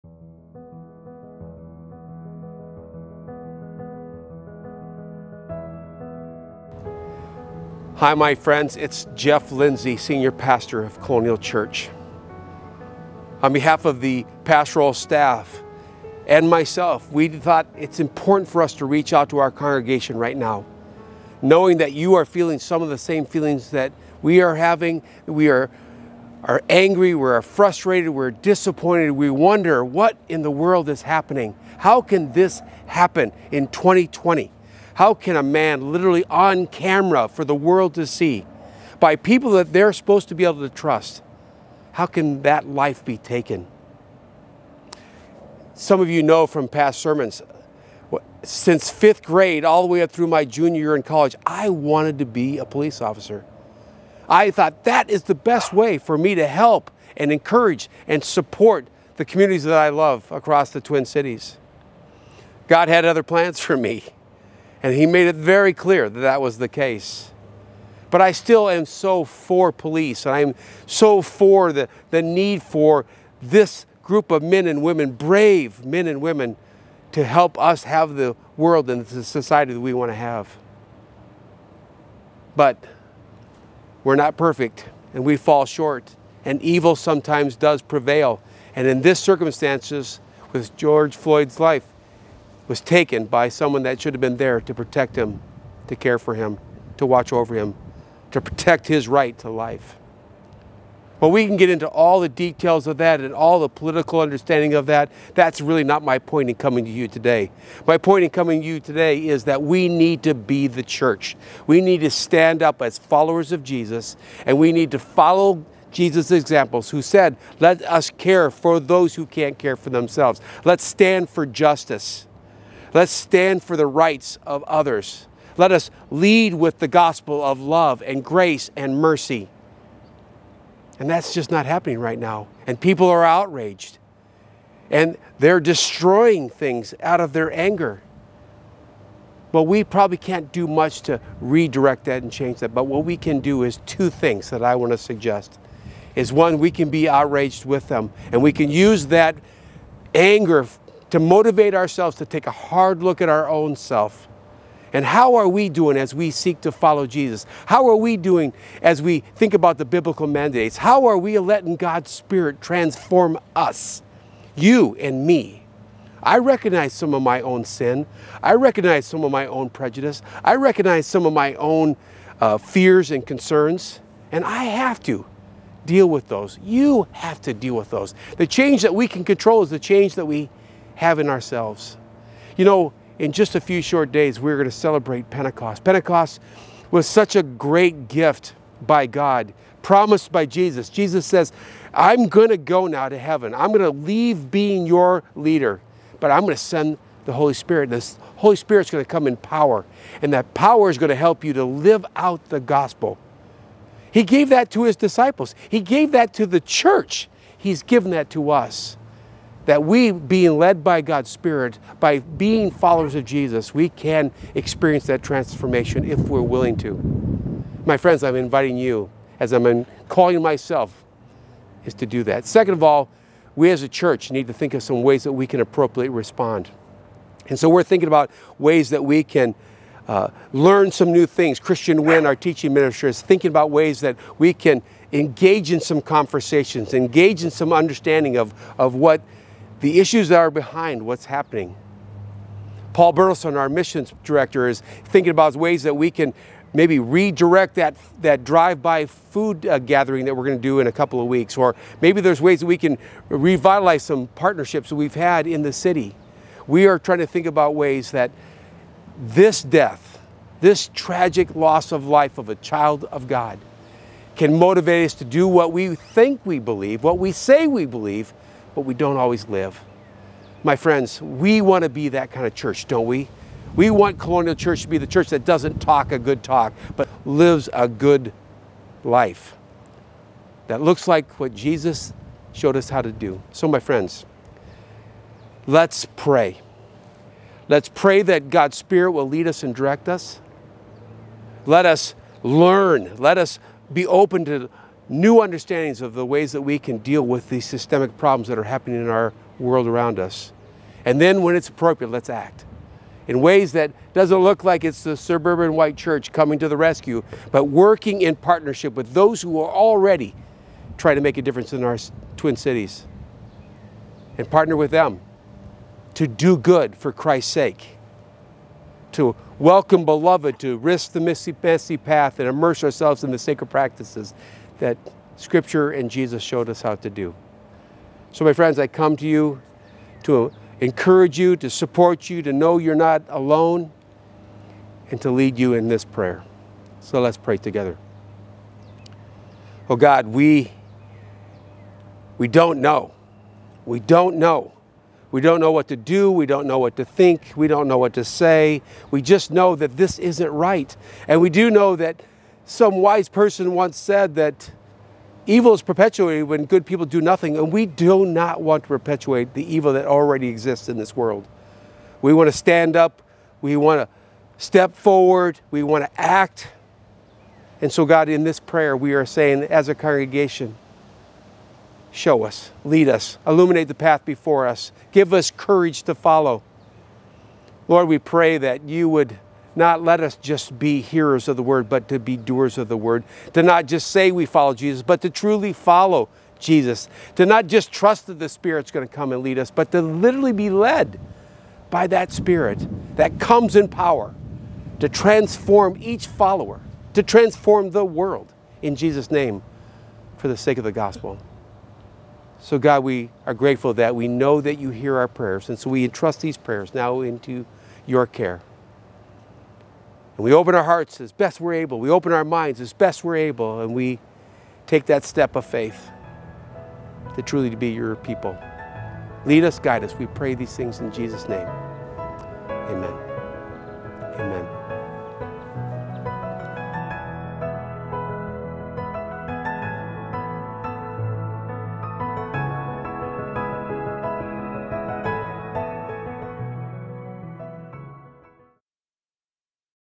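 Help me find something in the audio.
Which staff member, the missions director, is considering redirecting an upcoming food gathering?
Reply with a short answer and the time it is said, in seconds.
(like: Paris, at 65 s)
Paul Burleson, at 242 s.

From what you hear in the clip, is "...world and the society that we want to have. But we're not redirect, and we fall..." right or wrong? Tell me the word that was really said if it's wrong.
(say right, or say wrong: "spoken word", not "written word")
wrong: "perfect", not "redirect".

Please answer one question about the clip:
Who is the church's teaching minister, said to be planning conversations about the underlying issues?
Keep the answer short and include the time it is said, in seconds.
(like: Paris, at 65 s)
Christian Wynn, at 231 s.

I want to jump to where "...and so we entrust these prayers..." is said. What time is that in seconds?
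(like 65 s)
405 s.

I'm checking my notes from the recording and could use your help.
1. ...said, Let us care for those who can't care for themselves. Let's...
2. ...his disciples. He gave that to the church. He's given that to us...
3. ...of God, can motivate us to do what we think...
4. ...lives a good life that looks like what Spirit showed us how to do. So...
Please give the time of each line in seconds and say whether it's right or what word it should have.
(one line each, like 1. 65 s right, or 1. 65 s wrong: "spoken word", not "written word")
1. 117 s right
2. 204 s right
3. 263 s right
4. 277 s wrong: "Jesus", not "Spirit".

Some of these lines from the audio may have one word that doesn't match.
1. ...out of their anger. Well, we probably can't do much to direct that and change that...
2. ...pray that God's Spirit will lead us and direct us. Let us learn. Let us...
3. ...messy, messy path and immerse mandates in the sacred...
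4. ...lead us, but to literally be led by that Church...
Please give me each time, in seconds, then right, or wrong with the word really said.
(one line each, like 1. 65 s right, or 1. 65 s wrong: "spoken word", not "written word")
1. 137 s wrong: "redirect", not "direct"
2. 287 s right
3. 321 s wrong: "ourselves", not "mandates"
4. 389 s wrong: "Spirit", not "Church".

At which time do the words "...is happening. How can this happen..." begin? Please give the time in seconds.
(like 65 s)
30 s.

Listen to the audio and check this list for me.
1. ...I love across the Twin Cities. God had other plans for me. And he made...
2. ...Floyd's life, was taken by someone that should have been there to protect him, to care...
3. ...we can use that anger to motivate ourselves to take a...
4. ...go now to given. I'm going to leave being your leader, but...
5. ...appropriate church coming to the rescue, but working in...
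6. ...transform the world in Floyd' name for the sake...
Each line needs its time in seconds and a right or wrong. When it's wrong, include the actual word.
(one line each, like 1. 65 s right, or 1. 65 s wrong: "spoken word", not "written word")
1. 59 s right
2. 91 s right
3. 148 s right
4. 192 s wrong: "heaven", not "given"
5. 305 s wrong: "white", not "appropriate"
6. 397 s wrong: "Jesus", not "Floyd".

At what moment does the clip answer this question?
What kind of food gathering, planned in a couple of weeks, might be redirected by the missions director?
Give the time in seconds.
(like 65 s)
248 s.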